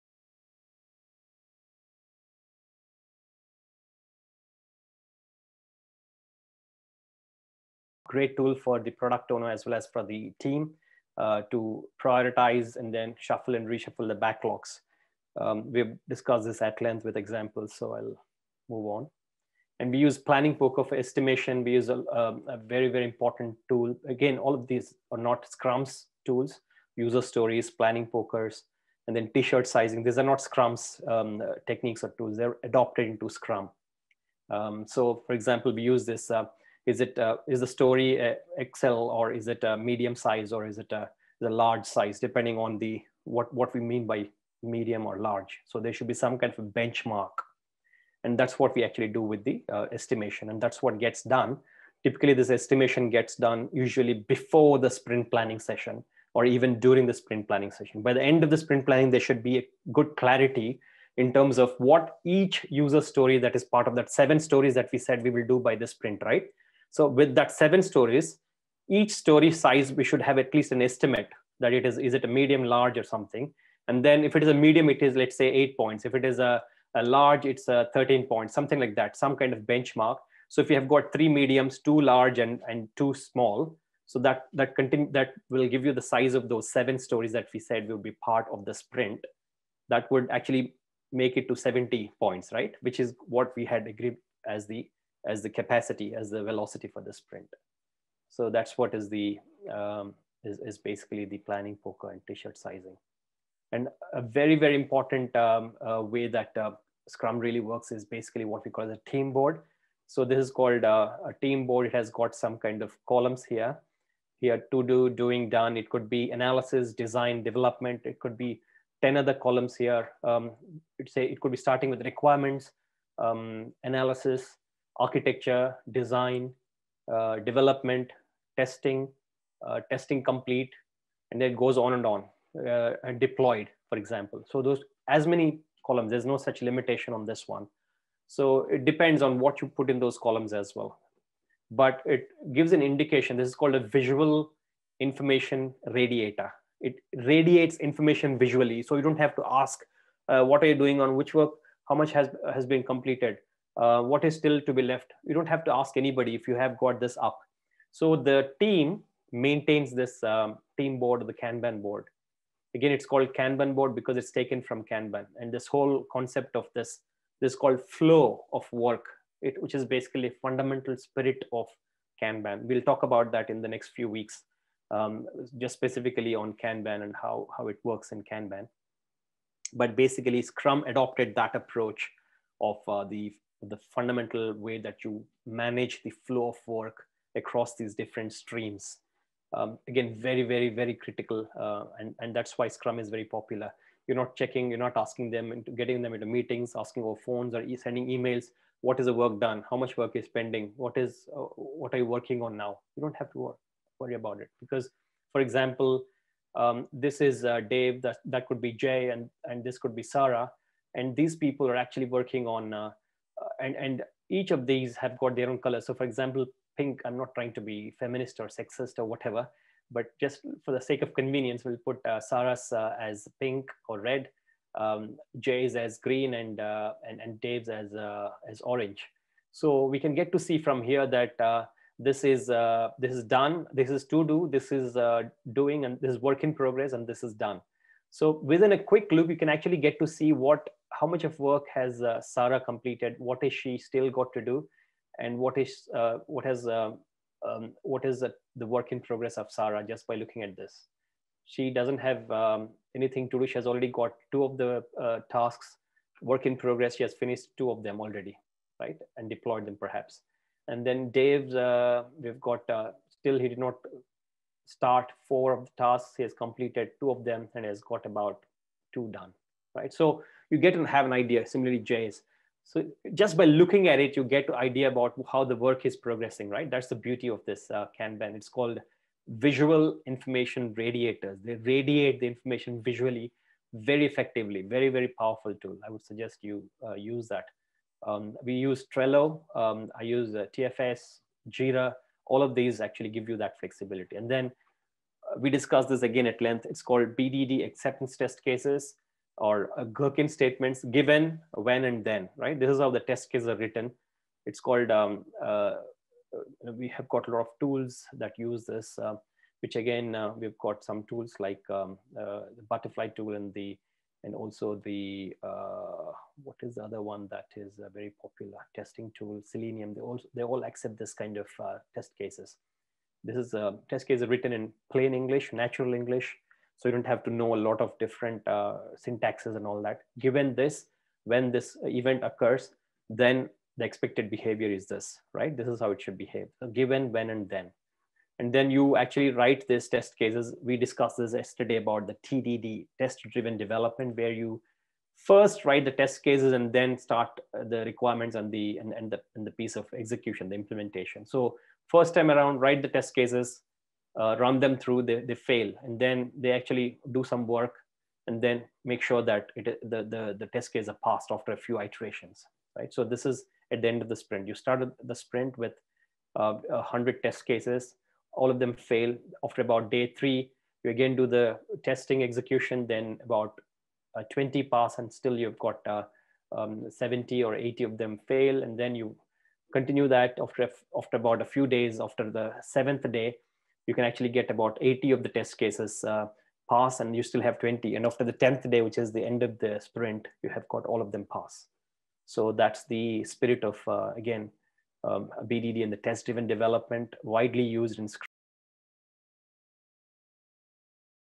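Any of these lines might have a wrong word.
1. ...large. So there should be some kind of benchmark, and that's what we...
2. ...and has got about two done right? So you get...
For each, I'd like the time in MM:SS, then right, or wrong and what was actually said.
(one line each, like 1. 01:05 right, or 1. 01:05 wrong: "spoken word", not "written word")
1. 00:45 right
2. 04:27 right.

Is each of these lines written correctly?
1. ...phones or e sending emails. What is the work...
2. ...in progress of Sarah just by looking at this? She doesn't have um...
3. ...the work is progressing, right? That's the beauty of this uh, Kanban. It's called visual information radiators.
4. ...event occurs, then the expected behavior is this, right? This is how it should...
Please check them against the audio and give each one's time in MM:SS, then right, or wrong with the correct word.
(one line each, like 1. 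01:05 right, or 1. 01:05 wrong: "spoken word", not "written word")
1. 03:17 right
2. 04:08 right
3. 04:35 right
4. 05:31 right.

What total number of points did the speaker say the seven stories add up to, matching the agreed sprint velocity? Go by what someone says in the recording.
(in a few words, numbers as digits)
70.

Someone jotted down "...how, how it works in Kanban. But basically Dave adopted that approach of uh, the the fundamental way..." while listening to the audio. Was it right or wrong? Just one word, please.
wrong.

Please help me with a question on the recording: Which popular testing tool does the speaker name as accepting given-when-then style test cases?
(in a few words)
Selenium.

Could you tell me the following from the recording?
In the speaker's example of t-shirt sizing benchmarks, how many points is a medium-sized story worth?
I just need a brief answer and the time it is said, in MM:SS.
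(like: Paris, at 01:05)
8, at 01:15.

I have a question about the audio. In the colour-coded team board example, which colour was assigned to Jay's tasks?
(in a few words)
green.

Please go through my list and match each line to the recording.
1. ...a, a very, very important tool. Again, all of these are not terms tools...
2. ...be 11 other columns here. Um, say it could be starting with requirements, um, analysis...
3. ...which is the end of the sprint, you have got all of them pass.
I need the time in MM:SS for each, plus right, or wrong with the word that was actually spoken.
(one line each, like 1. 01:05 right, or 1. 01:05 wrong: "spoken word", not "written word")
1. 00:21 wrong: "scrums", not "terms"
2. 01:58 wrong: "10", not "11"
3. 06:28 right.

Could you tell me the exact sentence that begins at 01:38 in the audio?
So that's what is the, um, is, is basically the planning poker and t-shirt sizing.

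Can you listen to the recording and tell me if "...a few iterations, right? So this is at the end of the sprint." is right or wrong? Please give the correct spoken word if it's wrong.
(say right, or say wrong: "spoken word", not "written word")
right.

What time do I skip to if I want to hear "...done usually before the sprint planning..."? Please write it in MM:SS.
00:53.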